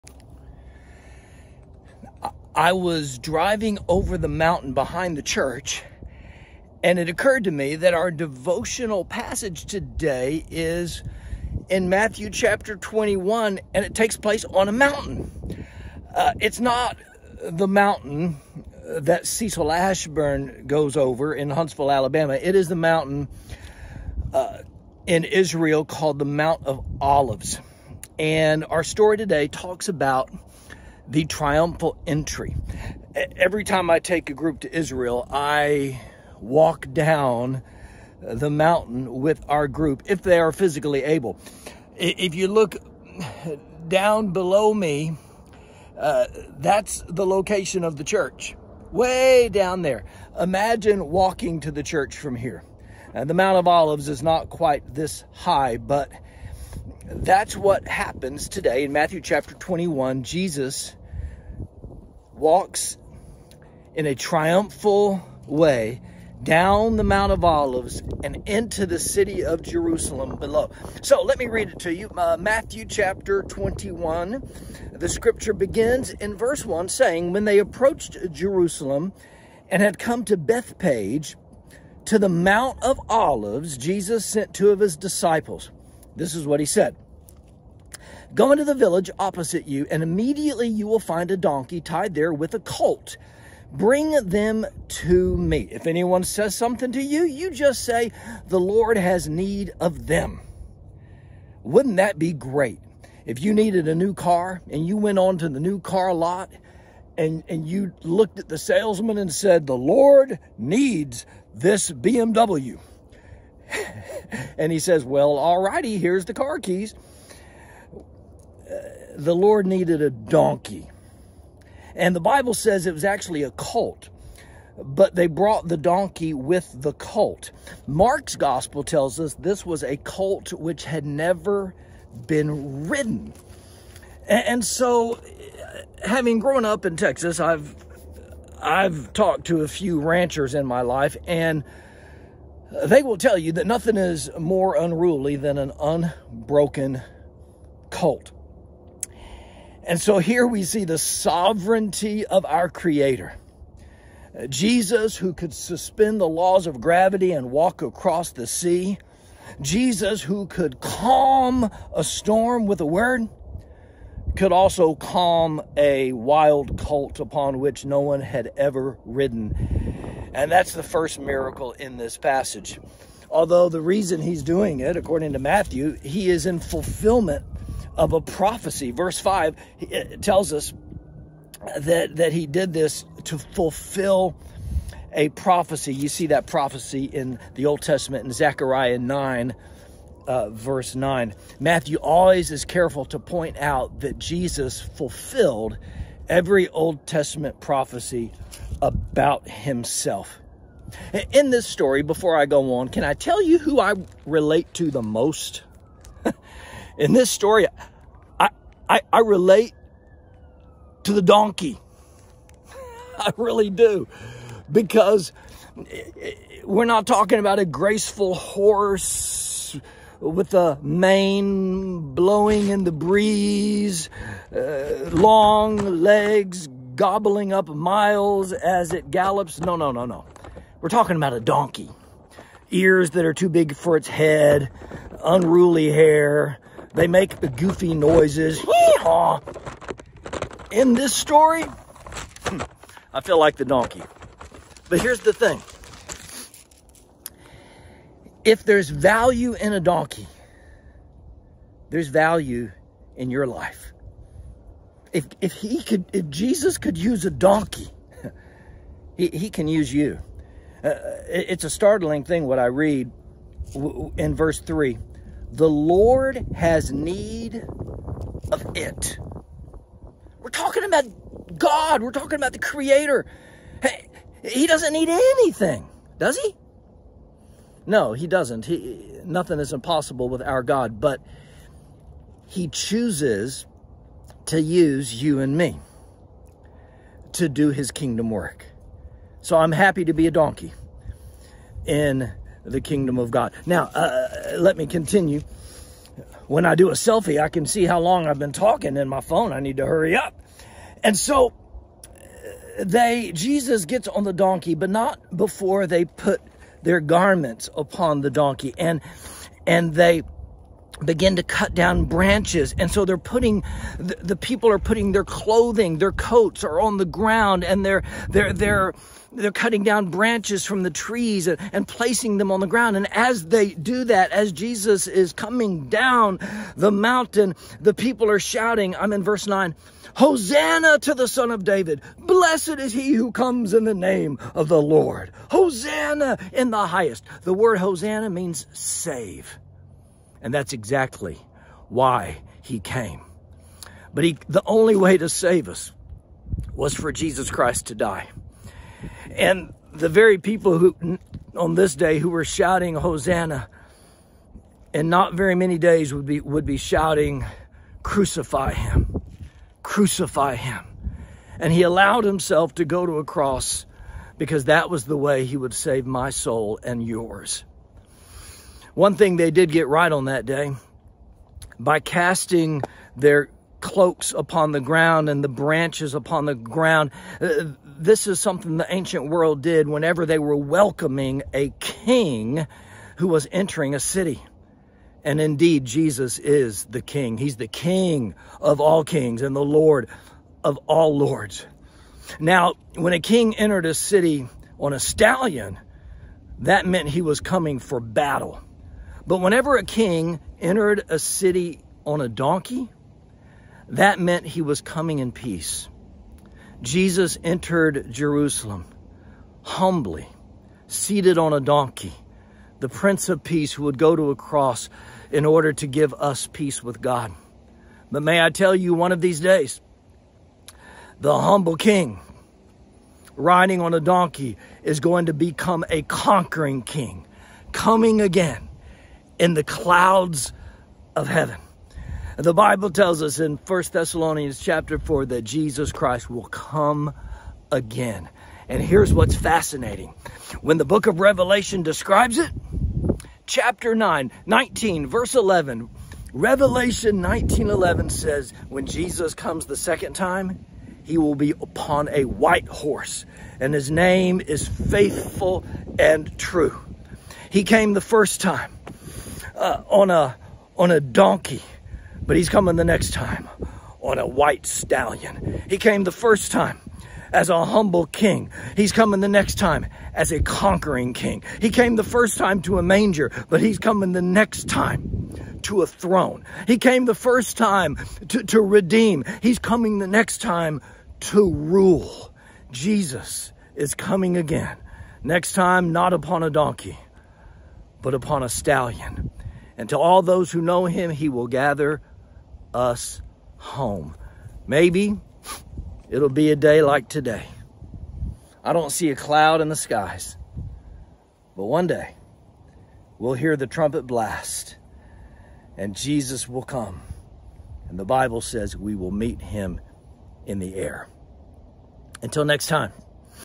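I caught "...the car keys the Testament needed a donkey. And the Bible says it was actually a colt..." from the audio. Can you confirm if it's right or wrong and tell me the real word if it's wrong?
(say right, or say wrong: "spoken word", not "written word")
wrong: "Lord", not "Testament".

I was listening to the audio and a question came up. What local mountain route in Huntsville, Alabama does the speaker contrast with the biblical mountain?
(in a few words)
Cecil Ashburn.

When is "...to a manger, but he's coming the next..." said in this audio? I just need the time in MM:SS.
07:52.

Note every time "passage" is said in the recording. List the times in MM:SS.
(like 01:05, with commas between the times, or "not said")
00:09, 02:52.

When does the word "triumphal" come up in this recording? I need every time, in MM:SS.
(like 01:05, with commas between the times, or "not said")
00:31, 01:04.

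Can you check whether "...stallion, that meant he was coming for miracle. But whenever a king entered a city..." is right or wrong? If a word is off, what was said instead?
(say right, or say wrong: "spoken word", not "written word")
wrong: "battle", not "miracle".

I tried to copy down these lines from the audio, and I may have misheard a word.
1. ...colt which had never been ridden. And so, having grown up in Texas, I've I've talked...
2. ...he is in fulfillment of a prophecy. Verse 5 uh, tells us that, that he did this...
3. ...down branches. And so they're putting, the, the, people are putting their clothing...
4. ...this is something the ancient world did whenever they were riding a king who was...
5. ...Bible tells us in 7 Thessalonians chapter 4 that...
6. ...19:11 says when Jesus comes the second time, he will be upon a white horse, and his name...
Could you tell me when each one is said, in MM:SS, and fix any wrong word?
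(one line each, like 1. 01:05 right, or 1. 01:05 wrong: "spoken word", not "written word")
1. 02:09 right
2. 02:55 right
3. 05:11 right
4. 06:17 wrong: "welcoming", not "riding"
5. 07:12 wrong: "1", not "7"
6. 07:27 right.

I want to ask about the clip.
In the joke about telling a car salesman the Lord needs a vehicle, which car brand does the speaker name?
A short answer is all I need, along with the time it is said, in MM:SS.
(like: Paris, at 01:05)
BMW, at 01:51.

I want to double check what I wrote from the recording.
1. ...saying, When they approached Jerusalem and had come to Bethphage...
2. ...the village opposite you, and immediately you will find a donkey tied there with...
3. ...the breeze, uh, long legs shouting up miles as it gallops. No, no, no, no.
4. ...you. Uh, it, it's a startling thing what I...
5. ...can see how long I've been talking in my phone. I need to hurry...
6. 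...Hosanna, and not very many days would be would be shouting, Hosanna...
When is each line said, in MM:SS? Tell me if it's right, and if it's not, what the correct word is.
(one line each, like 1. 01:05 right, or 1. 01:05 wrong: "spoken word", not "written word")
1. 01:16 right
2. 01:28 right
3. 03:42 wrong: "gobbling", not "shouting"
4. 04:19 right
5. 04:57 right
6. 05:52 wrong: "Crucify", not "Hosanna".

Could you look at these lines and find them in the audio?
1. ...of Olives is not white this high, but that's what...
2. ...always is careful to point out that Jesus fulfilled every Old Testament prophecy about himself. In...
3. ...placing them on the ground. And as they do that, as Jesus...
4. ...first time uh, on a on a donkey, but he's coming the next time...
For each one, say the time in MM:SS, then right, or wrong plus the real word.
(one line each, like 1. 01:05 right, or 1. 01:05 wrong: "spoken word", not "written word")
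1. 00:53 wrong: "quite", not "white"
2. 03:11 right
3. 05:21 right
4. 07:38 right.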